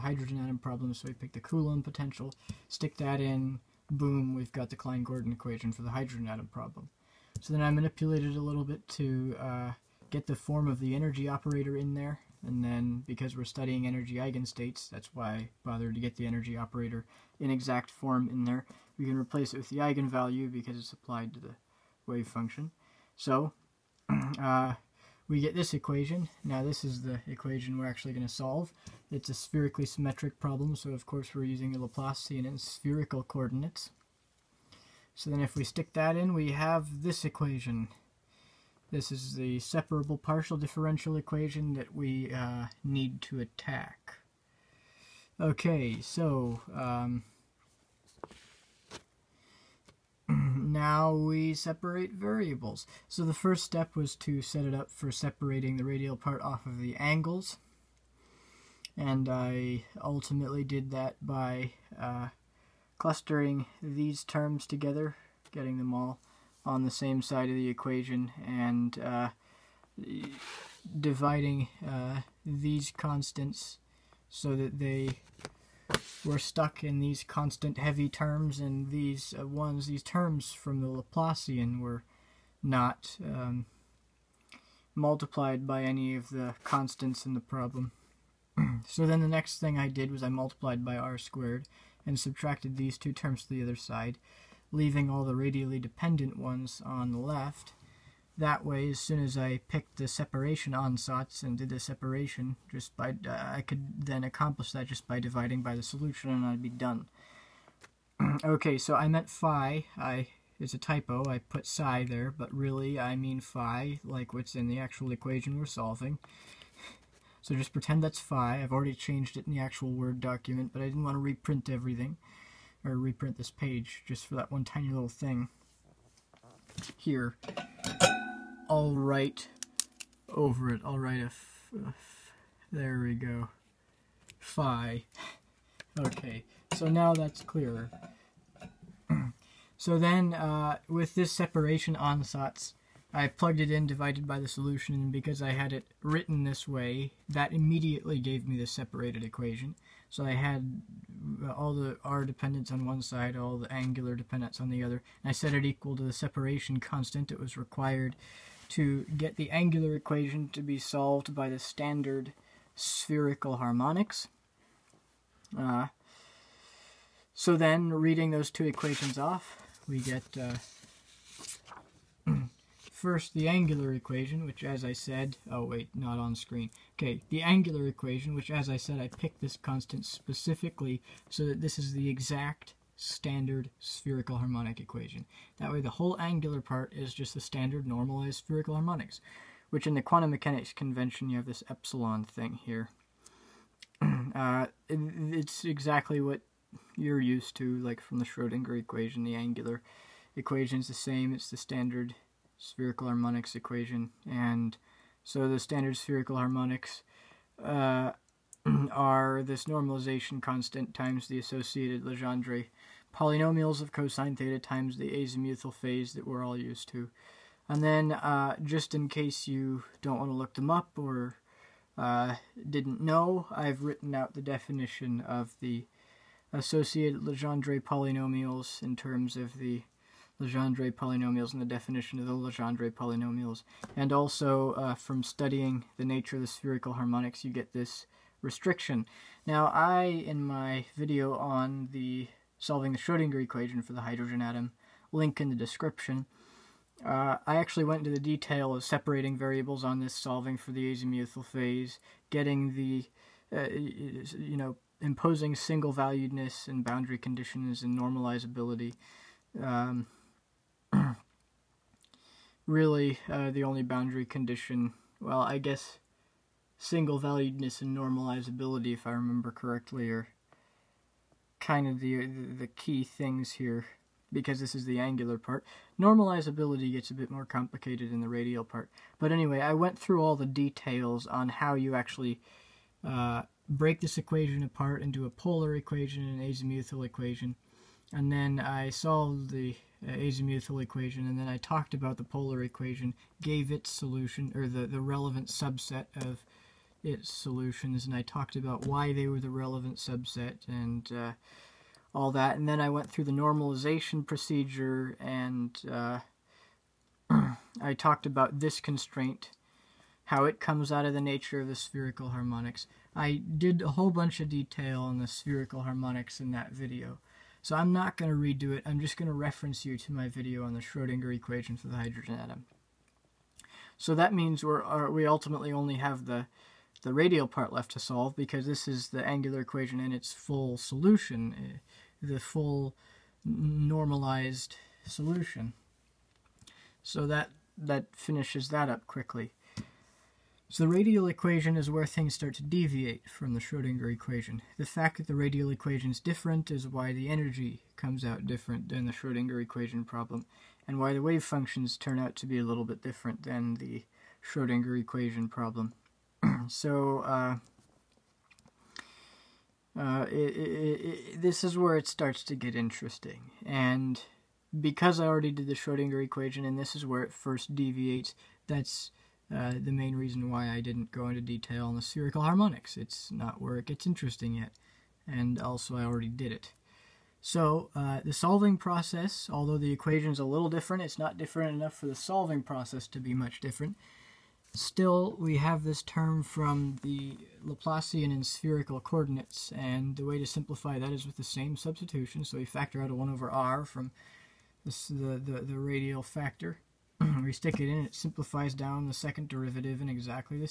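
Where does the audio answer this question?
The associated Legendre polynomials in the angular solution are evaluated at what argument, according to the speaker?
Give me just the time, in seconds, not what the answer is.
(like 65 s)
213 s.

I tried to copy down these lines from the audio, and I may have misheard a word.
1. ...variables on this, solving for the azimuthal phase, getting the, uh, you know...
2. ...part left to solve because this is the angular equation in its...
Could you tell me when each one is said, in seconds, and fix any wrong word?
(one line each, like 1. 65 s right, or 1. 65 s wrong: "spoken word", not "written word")
1. 249 s right
2. 327 s right.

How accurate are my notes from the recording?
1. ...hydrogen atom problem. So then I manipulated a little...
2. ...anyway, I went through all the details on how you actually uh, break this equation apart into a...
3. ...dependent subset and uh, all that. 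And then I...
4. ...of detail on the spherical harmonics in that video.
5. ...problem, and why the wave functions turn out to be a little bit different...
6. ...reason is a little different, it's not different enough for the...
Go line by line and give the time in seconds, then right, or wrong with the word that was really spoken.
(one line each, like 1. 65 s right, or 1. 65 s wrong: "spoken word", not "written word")
1. 5 s right
2. 279 s right
3. 299 s wrong: "relevant", not "dependent"
4. 314 s right
5. 350 s right
6. 379 s wrong: "equation", not "reason".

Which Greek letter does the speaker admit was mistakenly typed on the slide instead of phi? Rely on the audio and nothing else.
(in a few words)
psi.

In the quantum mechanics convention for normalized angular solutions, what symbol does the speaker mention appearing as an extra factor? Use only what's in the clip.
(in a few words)
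epsilon.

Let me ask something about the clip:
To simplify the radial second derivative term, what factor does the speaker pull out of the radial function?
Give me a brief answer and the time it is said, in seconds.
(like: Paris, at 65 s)
1 over r, at 393 s.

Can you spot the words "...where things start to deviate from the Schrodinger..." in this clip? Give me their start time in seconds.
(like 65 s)
341 s.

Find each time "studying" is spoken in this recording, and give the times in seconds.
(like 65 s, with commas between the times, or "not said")
13 s, 235 s.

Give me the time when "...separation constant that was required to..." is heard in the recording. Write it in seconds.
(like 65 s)
156 s.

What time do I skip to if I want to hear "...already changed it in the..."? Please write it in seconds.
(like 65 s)
118 s.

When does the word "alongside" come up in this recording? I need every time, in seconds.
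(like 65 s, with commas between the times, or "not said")
not said.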